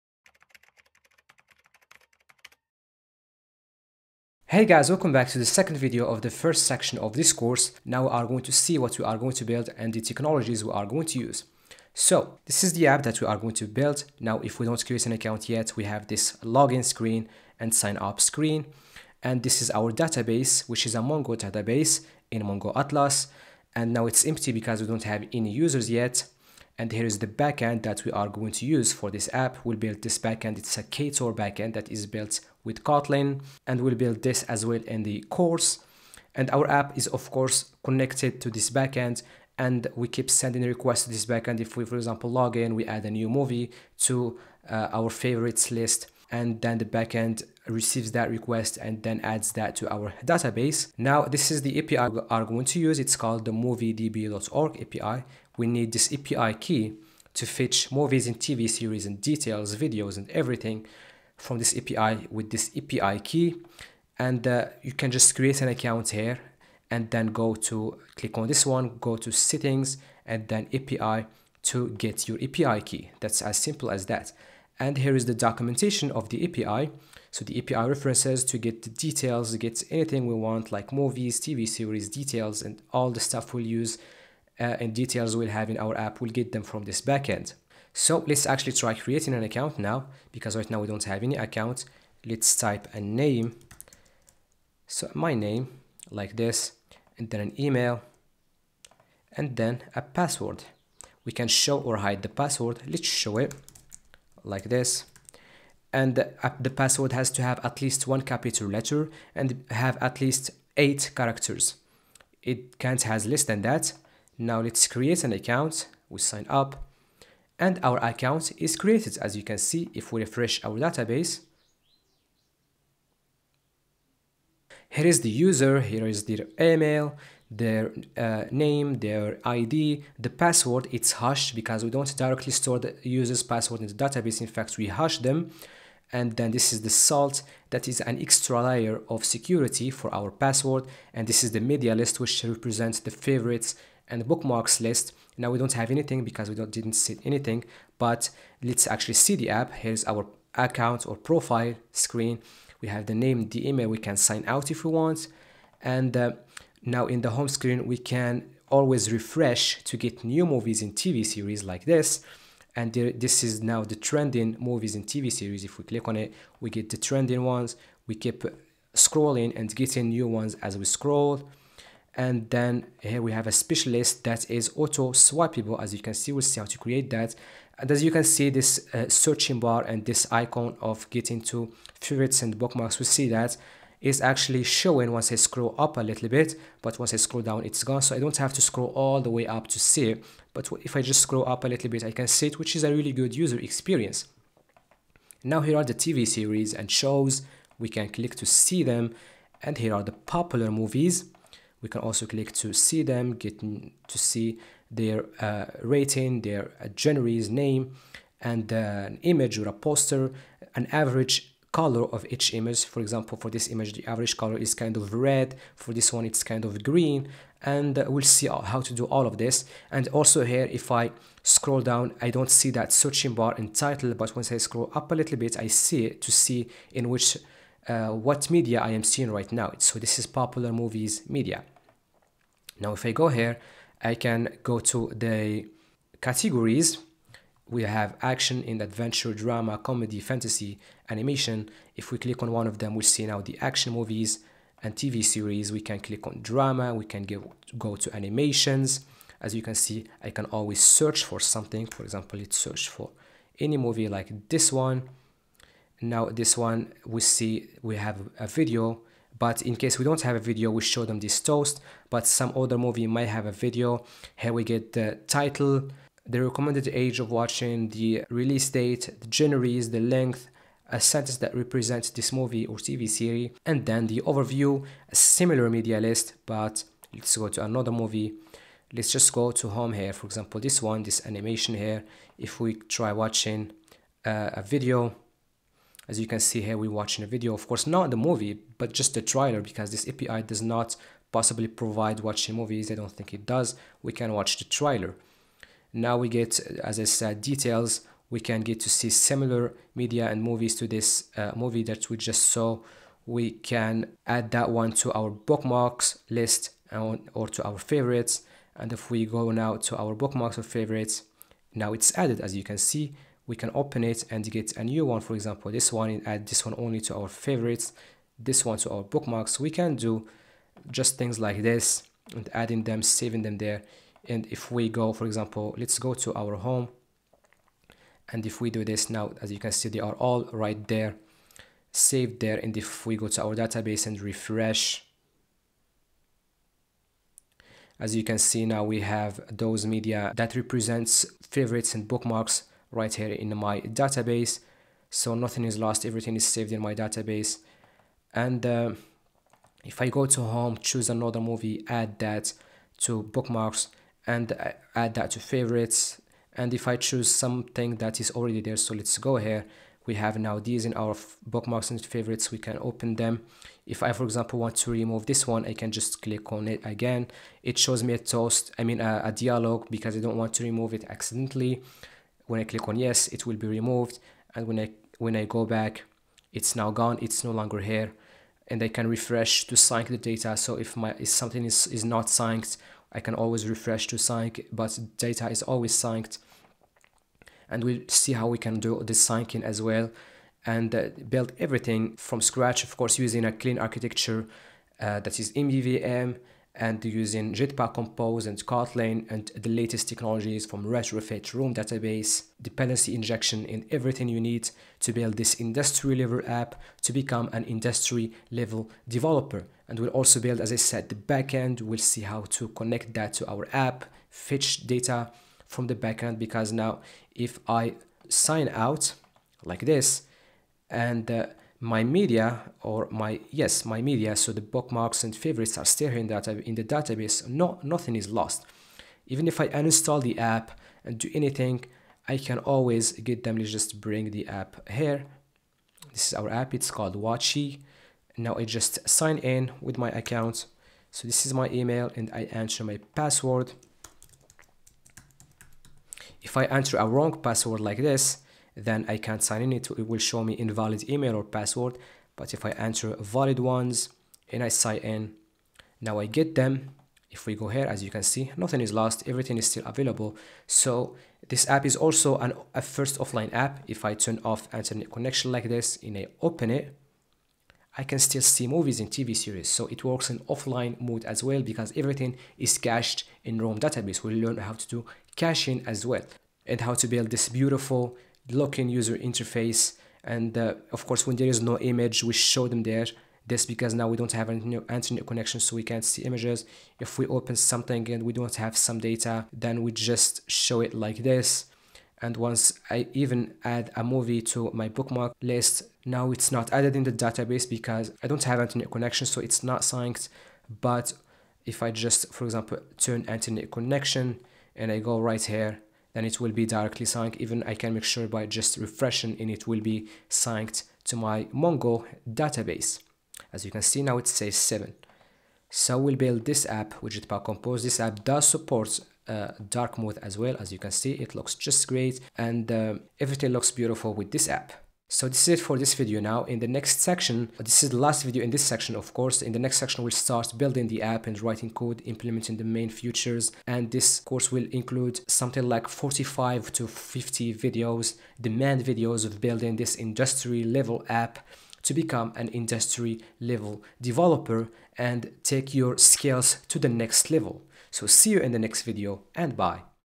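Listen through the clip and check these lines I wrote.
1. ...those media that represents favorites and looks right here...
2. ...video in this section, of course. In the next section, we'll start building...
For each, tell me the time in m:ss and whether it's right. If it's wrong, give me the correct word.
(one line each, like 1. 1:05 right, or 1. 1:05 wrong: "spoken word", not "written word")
1. 5:39 wrong: "bookmarks", not "looks"
2. 8:48 right.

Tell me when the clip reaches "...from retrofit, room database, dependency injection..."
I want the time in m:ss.
6:40.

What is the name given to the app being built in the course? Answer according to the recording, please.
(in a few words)
Watchy.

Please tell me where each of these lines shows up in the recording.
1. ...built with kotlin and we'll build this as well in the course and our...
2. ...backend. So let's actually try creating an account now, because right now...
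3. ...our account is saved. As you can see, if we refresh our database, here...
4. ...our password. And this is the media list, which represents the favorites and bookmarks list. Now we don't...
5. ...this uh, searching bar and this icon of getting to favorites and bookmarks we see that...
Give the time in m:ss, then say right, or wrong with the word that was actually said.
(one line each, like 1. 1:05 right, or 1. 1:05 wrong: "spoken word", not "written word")
1. 0:32 right
2. 1:27 right
3. 1:57 wrong: "created", not "saved"
4. 2:20 right
5. 2:58 right.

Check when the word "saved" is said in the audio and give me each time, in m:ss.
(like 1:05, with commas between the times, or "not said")
5:31, 5:46.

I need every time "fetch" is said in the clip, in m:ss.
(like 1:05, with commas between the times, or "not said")
0:57, 6:54.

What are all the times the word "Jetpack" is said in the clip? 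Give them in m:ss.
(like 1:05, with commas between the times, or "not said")
6:37, 8:37.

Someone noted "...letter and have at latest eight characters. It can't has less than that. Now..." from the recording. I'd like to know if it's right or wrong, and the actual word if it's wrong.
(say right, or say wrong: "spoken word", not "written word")
wrong: "least", not "latest".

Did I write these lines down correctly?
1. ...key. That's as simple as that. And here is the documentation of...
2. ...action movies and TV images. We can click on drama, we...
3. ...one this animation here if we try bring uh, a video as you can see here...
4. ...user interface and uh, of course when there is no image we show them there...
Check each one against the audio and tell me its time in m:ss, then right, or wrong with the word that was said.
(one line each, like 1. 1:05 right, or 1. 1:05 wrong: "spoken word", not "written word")
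1. 1:12 right
2. 4:03 wrong: "series", not "images"
3. 4:40 wrong: "watching", not "bring"
4. 7:58 right.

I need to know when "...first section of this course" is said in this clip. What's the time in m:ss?
0:06.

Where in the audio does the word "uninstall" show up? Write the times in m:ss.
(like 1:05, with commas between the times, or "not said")
7:09.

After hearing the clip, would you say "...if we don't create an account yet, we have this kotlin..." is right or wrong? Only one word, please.
wrong.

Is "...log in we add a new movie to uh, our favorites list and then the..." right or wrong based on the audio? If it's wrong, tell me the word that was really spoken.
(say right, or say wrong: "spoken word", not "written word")
right.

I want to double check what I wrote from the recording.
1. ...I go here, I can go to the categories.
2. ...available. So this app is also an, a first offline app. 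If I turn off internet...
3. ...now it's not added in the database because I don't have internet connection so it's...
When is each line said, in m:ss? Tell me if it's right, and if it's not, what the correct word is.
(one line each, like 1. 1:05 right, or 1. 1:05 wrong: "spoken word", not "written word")
1. 3:53 right
2. 7:39 right
3. 8:16 right.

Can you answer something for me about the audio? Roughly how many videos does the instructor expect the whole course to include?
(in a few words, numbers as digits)
45 to 50.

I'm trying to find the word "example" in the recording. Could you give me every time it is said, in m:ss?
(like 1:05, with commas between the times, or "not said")
0:41, 3:33, 4:12, 4:40, 5:15, 5:25, 6:04, 8:22.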